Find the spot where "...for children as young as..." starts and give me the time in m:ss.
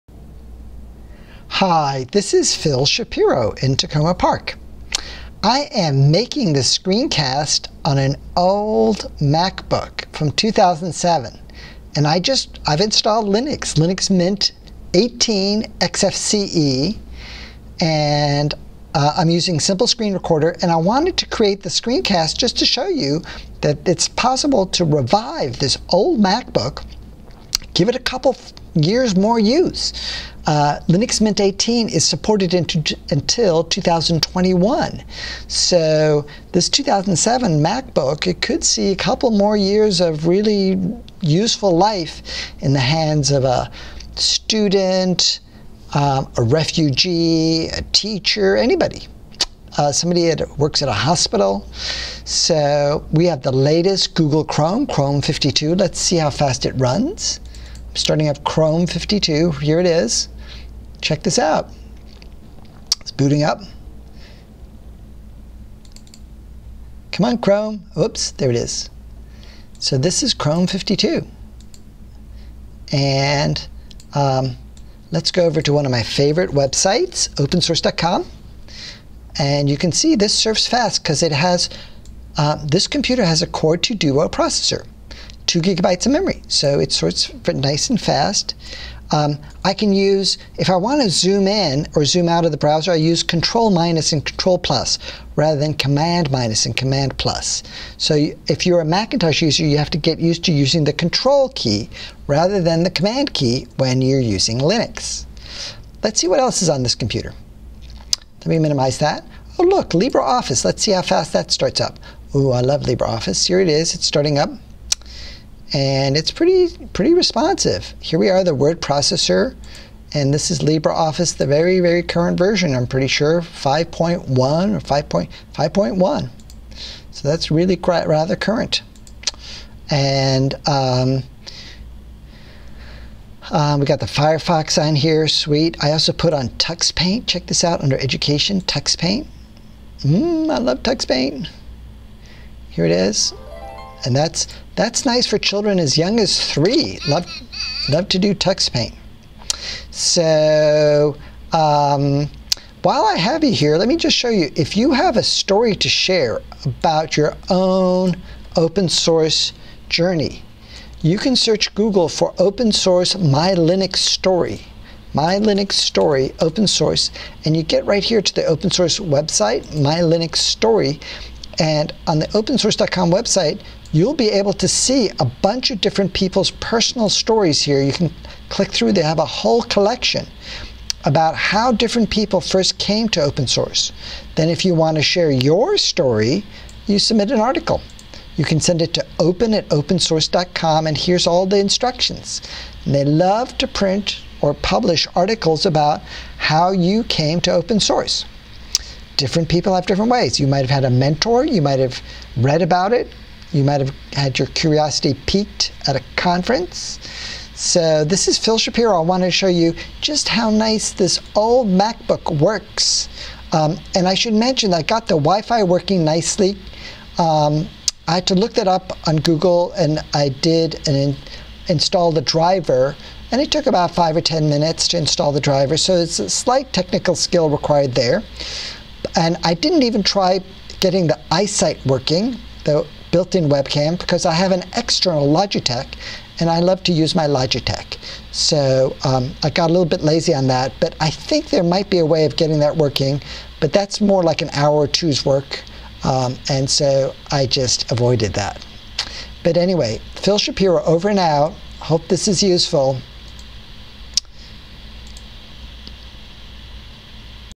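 2:25.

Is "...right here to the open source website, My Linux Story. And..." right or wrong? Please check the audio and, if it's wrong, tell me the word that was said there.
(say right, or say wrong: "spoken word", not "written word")
right.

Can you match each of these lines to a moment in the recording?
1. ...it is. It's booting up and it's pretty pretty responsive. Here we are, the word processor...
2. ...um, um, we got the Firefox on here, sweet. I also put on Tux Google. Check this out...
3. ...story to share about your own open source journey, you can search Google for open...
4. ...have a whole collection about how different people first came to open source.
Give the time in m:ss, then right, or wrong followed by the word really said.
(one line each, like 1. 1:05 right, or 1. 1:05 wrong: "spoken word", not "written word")
1. 1:53 wrong: "starting", not "booting"
2. 2:10 wrong: "Paint", not "Google"
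3. 2:35 right
4. 2:59 right.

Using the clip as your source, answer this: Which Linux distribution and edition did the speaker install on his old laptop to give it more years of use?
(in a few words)
Linux Mint 18 XFCE.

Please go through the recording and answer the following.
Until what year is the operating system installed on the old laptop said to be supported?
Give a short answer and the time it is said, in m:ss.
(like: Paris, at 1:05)
2021, at 0:33.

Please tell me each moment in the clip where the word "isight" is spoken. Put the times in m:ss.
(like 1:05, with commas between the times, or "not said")
3:51.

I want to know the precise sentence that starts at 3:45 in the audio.
So it's a slight technical skill required there.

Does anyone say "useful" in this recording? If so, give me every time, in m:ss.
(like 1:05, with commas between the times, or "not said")
0:41, 4:12.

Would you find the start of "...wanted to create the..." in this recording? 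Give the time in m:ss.
0:20.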